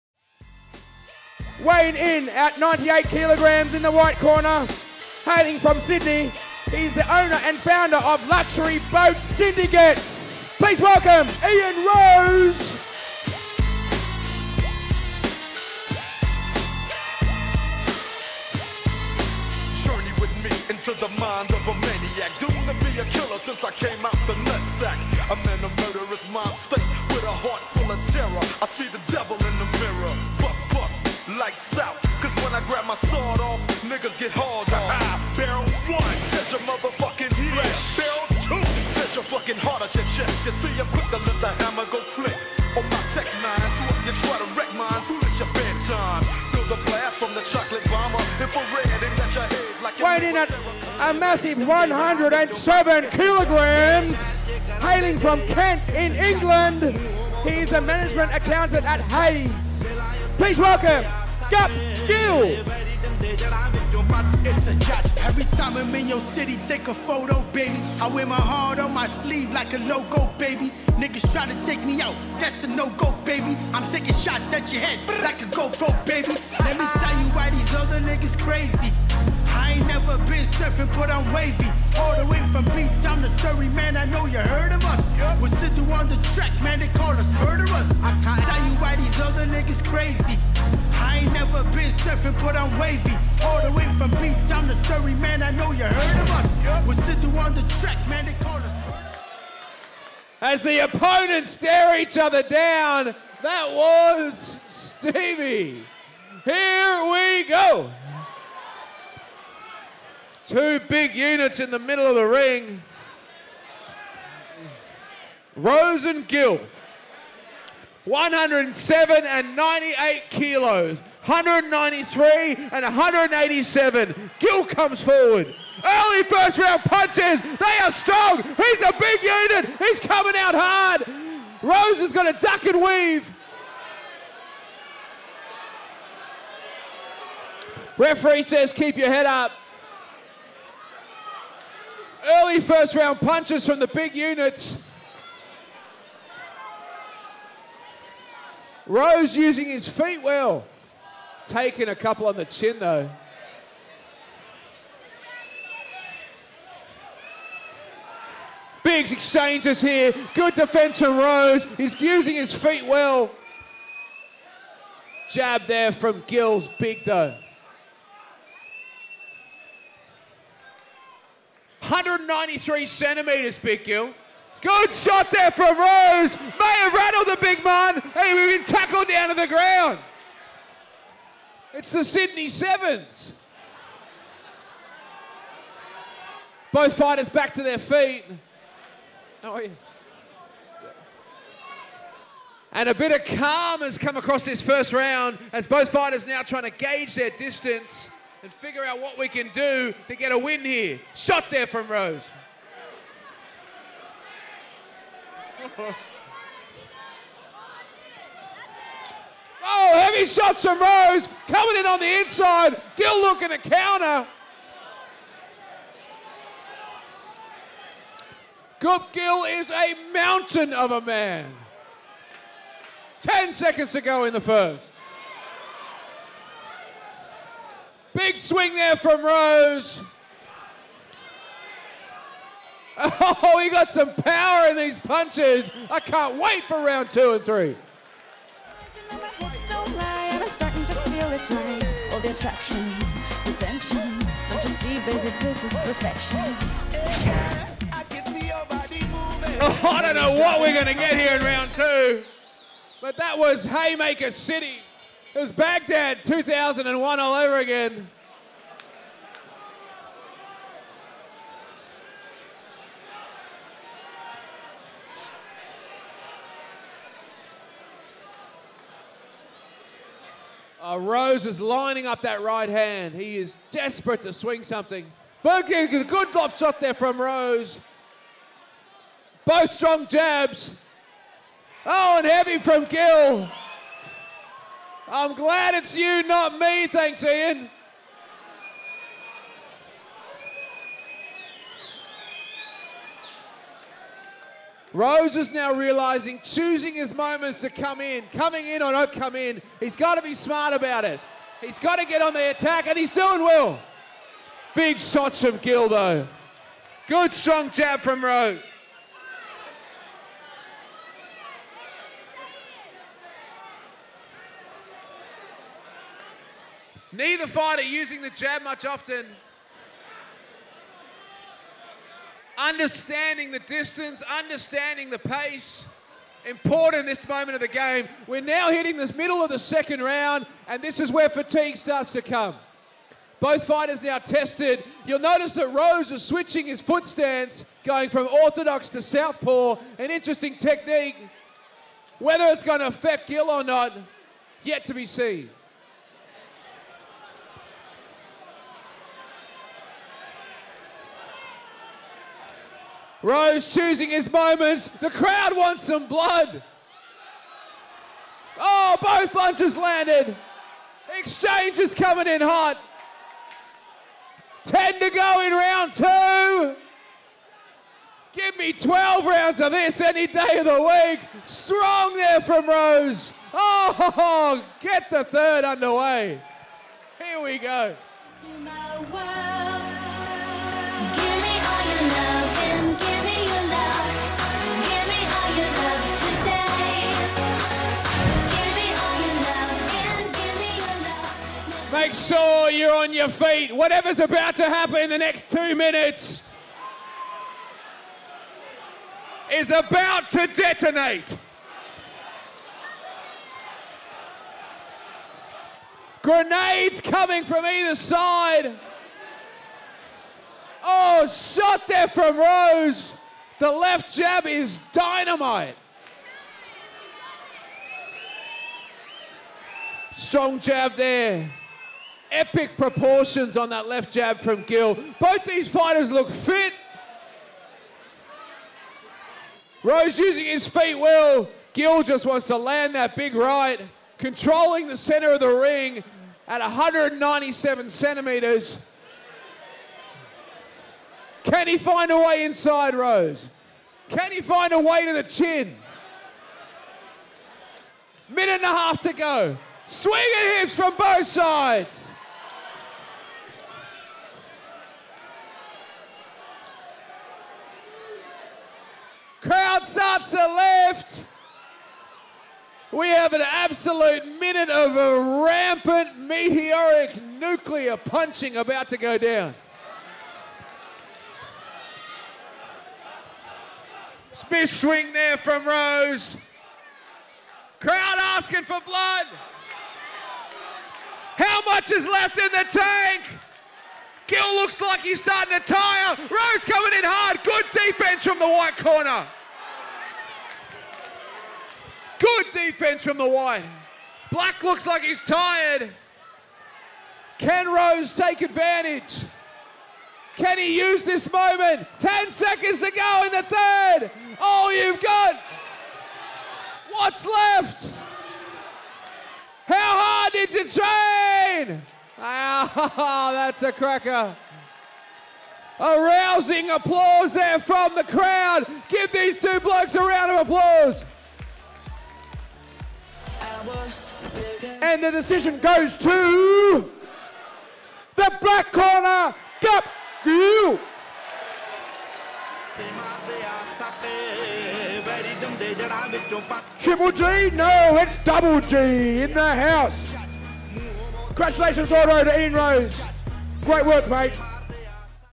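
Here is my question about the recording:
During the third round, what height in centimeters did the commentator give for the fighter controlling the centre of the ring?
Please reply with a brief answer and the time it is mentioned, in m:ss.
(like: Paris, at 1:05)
197, at 7:16.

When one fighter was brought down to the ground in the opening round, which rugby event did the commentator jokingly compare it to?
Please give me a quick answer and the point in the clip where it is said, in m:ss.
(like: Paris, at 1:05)
Sydney Sevens, at 3:02.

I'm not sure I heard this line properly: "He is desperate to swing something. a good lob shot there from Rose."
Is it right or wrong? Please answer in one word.
right.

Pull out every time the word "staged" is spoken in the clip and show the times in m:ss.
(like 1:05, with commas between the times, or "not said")
not said.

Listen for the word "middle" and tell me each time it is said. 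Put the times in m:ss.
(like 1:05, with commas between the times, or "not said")
1:51, 5:29.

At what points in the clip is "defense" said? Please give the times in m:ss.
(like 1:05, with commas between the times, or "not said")
2:40, 8:07, 8:12.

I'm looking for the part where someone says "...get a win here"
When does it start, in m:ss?
3:20.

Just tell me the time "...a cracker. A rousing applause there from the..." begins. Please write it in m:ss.
8:33.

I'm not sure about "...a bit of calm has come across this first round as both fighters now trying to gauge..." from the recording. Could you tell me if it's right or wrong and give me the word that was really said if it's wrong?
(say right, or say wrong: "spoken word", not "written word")
right.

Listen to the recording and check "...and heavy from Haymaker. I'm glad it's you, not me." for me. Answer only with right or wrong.
wrong.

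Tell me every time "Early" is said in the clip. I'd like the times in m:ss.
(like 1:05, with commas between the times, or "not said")
2:05, 2:22.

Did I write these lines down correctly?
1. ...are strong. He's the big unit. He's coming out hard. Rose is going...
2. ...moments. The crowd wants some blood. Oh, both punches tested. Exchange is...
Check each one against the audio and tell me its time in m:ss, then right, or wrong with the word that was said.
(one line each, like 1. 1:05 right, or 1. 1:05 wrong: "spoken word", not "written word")
1. 2:07 right
2. 5:54 wrong: "landed", not "tested".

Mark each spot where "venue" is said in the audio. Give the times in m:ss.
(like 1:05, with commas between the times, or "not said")
not said.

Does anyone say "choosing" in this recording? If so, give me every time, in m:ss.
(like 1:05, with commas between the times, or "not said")
4:56, 5:53.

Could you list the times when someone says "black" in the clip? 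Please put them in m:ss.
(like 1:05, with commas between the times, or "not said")
8:14, 8:48.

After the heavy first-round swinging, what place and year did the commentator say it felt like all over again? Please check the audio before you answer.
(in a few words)
Baghdad 2001.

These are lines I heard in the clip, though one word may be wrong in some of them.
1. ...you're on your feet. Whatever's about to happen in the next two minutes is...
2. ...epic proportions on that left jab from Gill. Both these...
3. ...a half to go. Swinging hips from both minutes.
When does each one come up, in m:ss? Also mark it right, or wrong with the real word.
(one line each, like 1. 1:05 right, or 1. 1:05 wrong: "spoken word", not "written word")
1. 6:32 right
2. 7:02 right
3. 7:28 wrong: "sides", not "minutes".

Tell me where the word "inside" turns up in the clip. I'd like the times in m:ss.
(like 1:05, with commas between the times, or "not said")
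3:32, 7:22.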